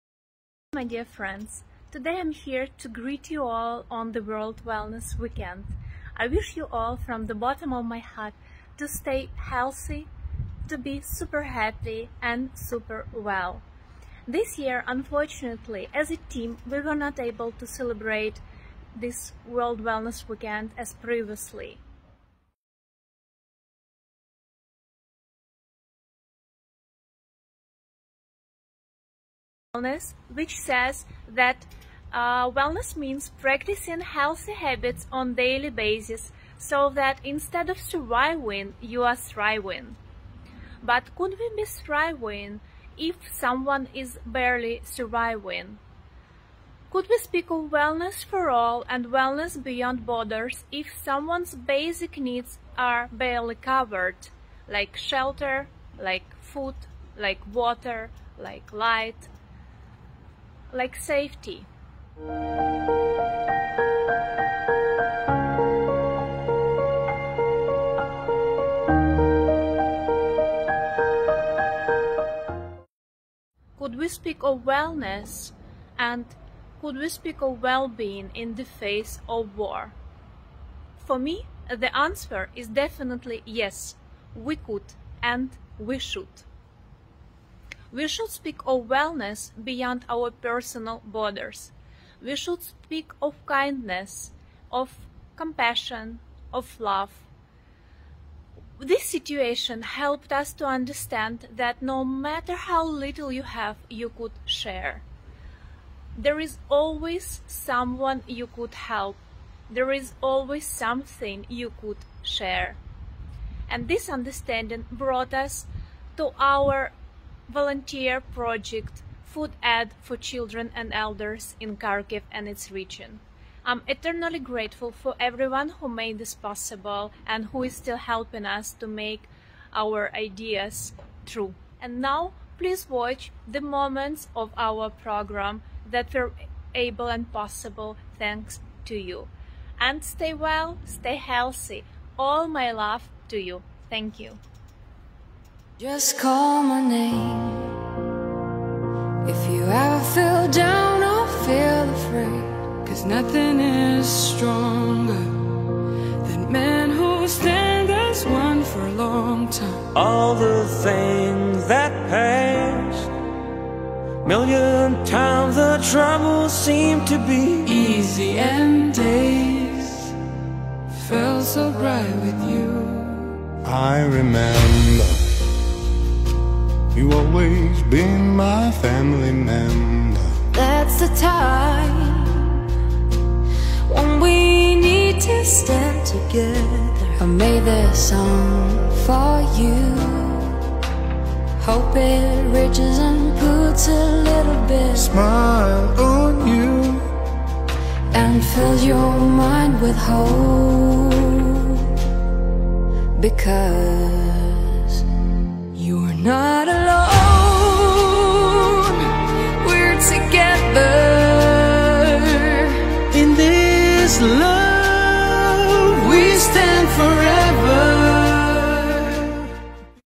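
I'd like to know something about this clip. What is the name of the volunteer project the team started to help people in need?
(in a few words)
Food Aid for Children and Elders.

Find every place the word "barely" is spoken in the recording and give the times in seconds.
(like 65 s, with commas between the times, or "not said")
44 s, 53 s.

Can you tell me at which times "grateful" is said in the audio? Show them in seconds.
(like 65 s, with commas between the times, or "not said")
124 s.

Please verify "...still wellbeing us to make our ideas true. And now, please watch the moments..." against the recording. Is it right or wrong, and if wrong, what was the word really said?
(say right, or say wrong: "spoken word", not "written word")
wrong: "helping", not "wellbeing".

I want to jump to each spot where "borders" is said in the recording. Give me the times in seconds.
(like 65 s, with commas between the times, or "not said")
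50 s, 91 s.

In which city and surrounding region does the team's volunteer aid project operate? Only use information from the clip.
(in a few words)
Kharkiv.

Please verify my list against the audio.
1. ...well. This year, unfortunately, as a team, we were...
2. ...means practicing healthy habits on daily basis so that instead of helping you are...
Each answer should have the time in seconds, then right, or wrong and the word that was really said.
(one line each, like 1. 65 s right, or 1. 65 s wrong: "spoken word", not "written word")
1. 13 s right
2. 32 s wrong: "surviving", not "helping".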